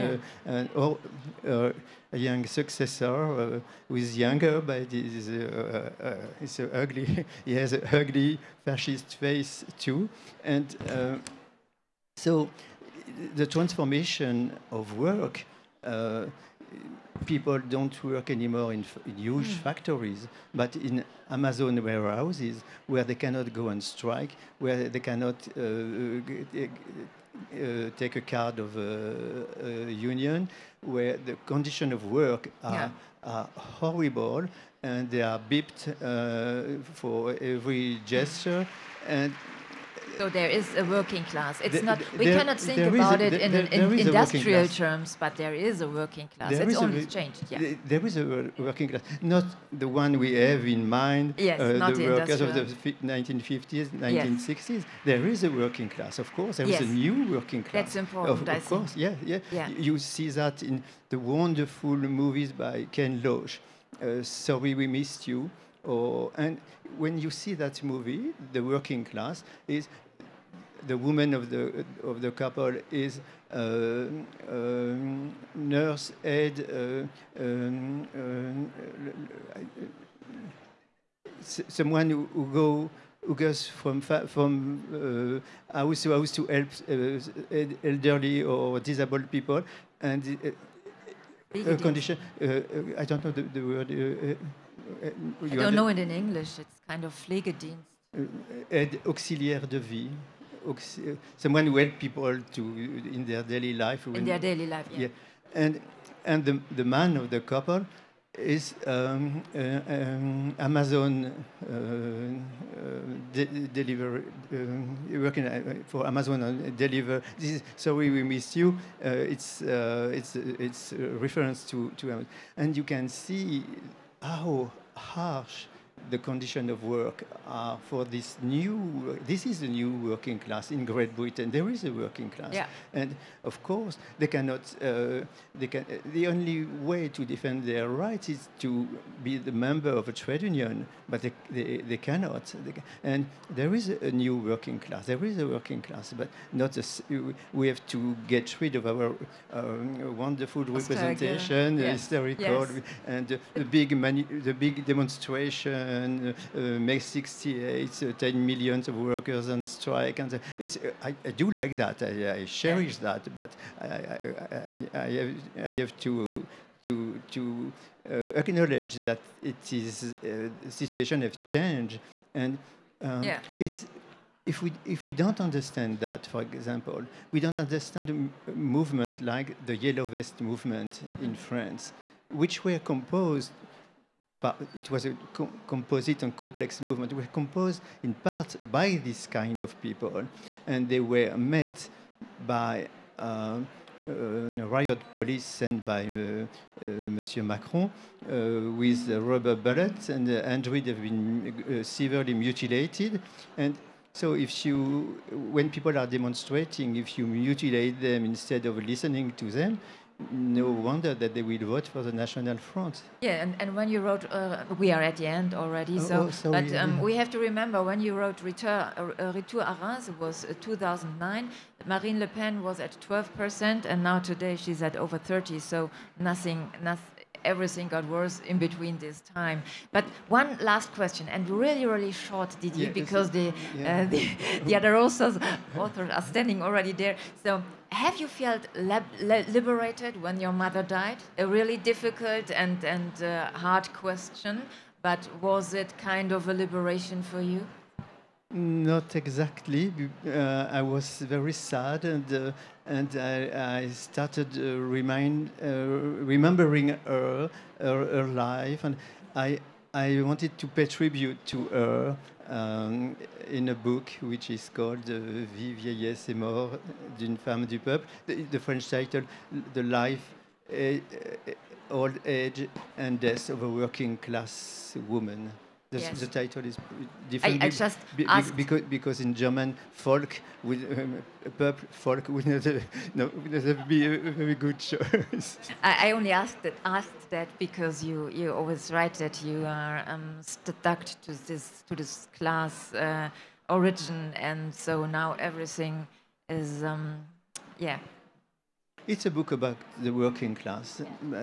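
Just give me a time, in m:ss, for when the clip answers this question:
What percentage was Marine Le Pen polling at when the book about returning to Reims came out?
3:43.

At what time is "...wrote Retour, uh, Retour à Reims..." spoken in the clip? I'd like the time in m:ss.
3:38.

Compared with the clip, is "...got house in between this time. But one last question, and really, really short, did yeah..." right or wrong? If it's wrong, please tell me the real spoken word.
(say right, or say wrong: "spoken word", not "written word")
wrong: "worse", not "house".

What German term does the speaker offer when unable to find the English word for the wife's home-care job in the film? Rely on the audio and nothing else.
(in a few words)
Pflegedienst.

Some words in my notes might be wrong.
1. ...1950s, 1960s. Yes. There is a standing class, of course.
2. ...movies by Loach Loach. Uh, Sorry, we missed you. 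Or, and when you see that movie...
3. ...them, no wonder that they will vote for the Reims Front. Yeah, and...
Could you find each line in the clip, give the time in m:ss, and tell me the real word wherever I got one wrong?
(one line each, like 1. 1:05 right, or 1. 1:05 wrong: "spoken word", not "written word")
1. 0:53 wrong: "working", not "standing"
2. 1:01 wrong: "Ken", not "Loach"
3. 3:29 wrong: "National", not "Reims".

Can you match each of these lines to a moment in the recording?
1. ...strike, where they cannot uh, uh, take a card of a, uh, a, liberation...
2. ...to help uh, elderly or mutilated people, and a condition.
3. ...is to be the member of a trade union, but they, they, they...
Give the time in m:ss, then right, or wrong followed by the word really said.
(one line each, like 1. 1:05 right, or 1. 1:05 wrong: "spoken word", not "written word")
1. 0:23 wrong: "union", not "liberation"
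2. 1:26 wrong: "disabled", not "mutilated"
3. 2:18 right.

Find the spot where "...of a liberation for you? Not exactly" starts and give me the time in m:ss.
4:06.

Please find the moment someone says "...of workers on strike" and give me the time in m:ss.
2:38.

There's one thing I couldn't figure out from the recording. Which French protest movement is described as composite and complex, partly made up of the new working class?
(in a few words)
Yellow vest movement.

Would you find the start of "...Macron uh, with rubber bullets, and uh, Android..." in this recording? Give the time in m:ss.
3:17.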